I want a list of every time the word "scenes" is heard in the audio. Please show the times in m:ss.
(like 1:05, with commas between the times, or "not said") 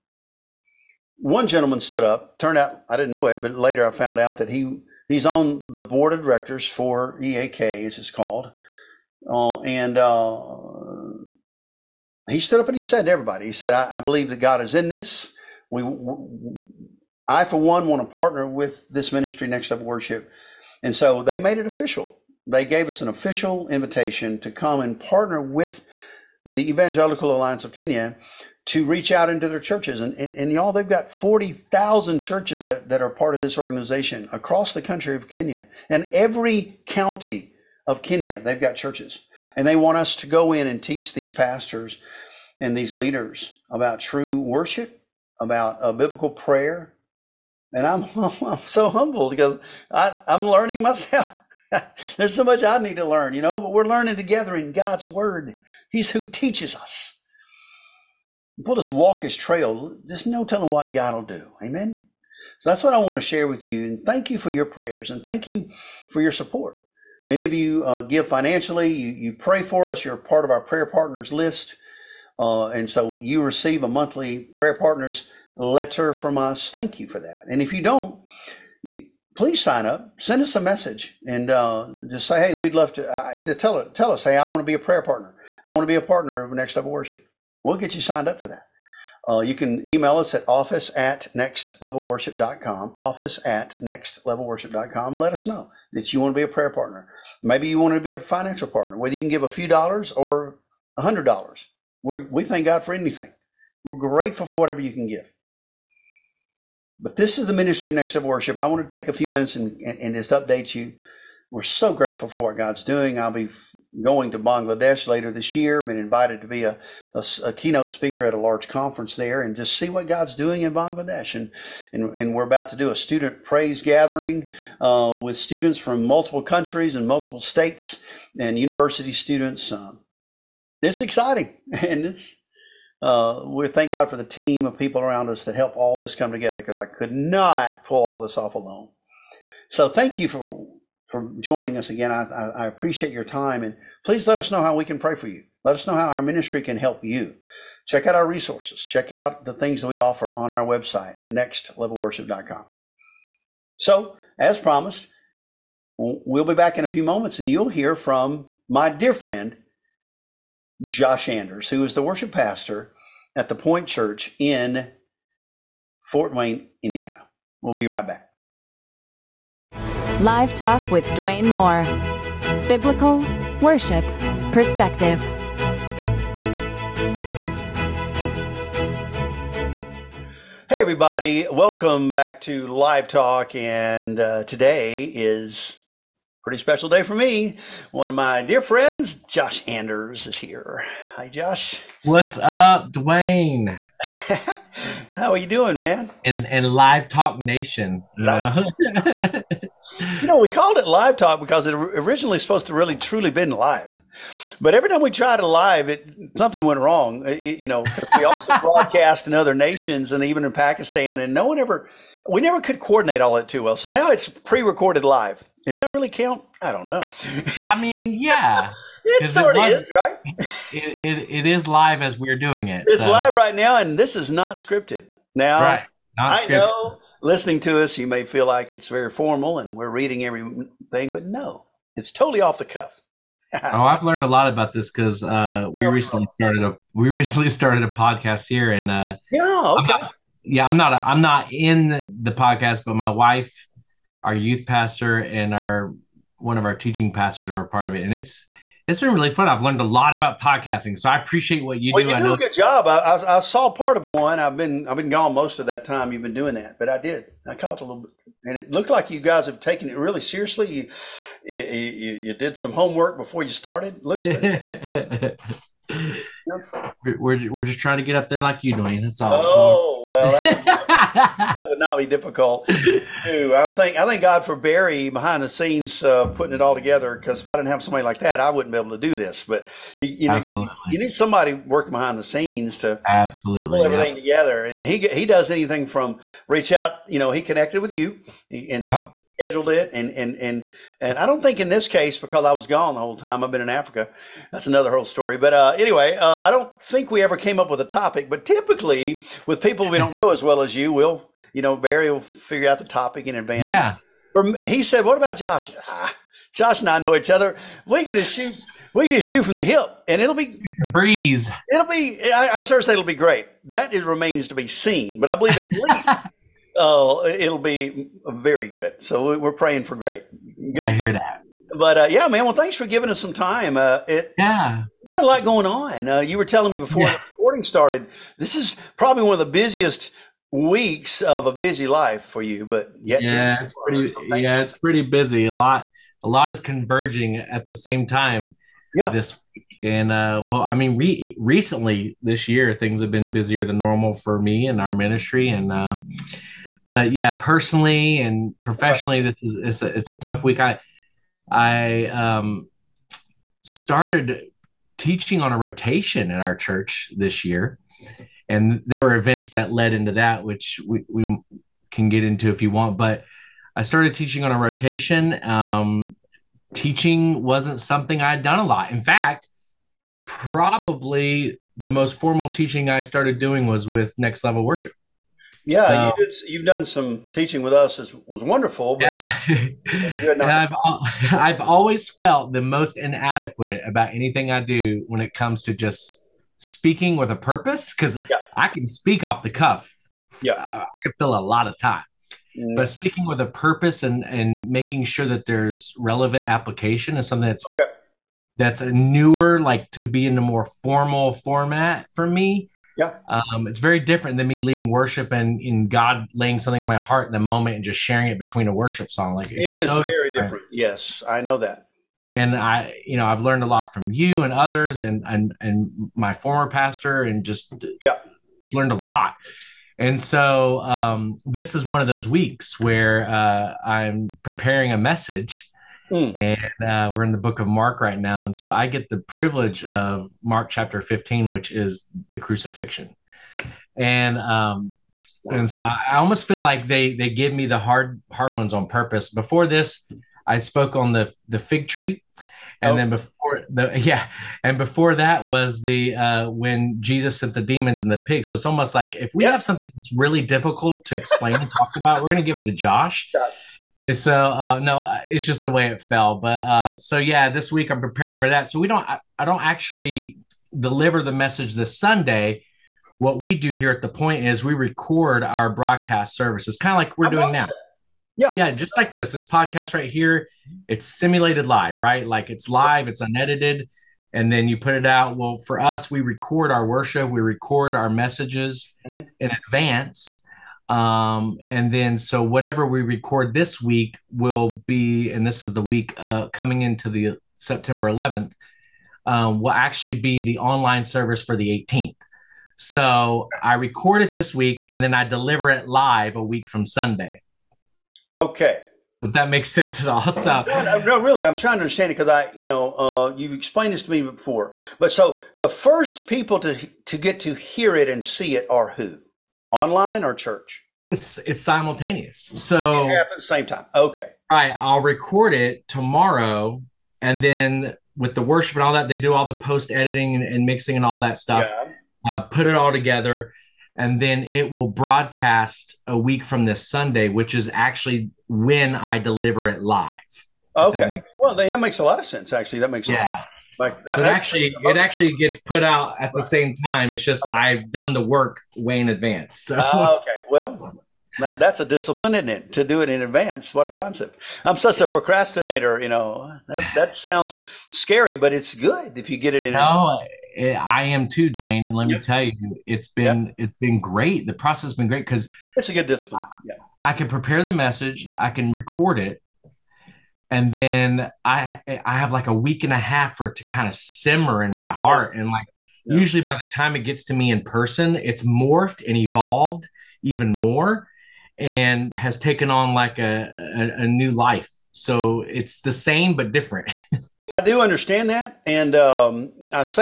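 4:35, 4:42.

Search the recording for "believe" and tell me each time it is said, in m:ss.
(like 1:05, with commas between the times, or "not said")
0:13, 5:15.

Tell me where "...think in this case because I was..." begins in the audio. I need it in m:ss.
4:51.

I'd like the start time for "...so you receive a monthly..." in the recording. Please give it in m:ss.
1:12.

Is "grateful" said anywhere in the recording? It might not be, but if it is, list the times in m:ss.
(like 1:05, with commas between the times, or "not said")
1:43, 1:51.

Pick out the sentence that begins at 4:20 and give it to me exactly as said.
You you, you, did some homework before you started.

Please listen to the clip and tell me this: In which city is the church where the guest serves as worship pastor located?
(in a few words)
Fort Wayne, Indiana.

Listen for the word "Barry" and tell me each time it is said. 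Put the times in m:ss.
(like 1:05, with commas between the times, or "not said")
4:34, 5:01.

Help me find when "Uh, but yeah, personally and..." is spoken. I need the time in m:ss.
5:45.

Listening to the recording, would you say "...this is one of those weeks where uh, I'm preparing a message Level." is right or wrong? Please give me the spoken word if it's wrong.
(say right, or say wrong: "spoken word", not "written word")
wrong: "Hmm", not "Level".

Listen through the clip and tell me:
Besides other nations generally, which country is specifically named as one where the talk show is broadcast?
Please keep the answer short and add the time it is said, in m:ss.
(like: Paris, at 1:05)
Pakistan, at 3:30.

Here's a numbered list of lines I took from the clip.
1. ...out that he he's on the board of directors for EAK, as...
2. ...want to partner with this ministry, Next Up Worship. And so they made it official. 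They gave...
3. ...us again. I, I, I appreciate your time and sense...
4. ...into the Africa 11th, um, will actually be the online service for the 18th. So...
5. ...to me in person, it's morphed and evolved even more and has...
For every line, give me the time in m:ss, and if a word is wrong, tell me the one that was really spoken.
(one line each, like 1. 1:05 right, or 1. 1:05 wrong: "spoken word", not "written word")
1. 0:04 right
2. 0:17 right
3. 2:21 wrong: "please", not "sense"
4. 8:06 wrong: "September", not "Africa"
5. 9:27 right.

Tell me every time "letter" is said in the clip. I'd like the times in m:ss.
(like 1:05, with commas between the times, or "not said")
1:15.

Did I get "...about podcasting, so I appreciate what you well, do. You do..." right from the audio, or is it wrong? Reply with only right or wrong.
right.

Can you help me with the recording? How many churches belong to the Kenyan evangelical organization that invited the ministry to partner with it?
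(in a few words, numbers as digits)
40,000.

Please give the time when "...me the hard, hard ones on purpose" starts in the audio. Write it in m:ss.
7:17.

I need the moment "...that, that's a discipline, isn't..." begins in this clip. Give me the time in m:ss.
9:01.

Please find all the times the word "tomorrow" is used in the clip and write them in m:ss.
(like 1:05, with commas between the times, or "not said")
8:35.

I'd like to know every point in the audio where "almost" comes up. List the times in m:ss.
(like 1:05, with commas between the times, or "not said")
7:16, 7:28.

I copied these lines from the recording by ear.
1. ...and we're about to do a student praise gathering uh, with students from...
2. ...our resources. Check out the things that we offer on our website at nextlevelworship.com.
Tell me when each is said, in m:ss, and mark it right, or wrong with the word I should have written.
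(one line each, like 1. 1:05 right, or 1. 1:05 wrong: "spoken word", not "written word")
1. 2:02 right
2. 2:28 right.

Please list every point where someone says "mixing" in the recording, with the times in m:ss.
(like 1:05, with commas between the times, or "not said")
8:40.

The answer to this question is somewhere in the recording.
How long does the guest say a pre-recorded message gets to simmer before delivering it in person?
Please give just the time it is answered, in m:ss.
9:22.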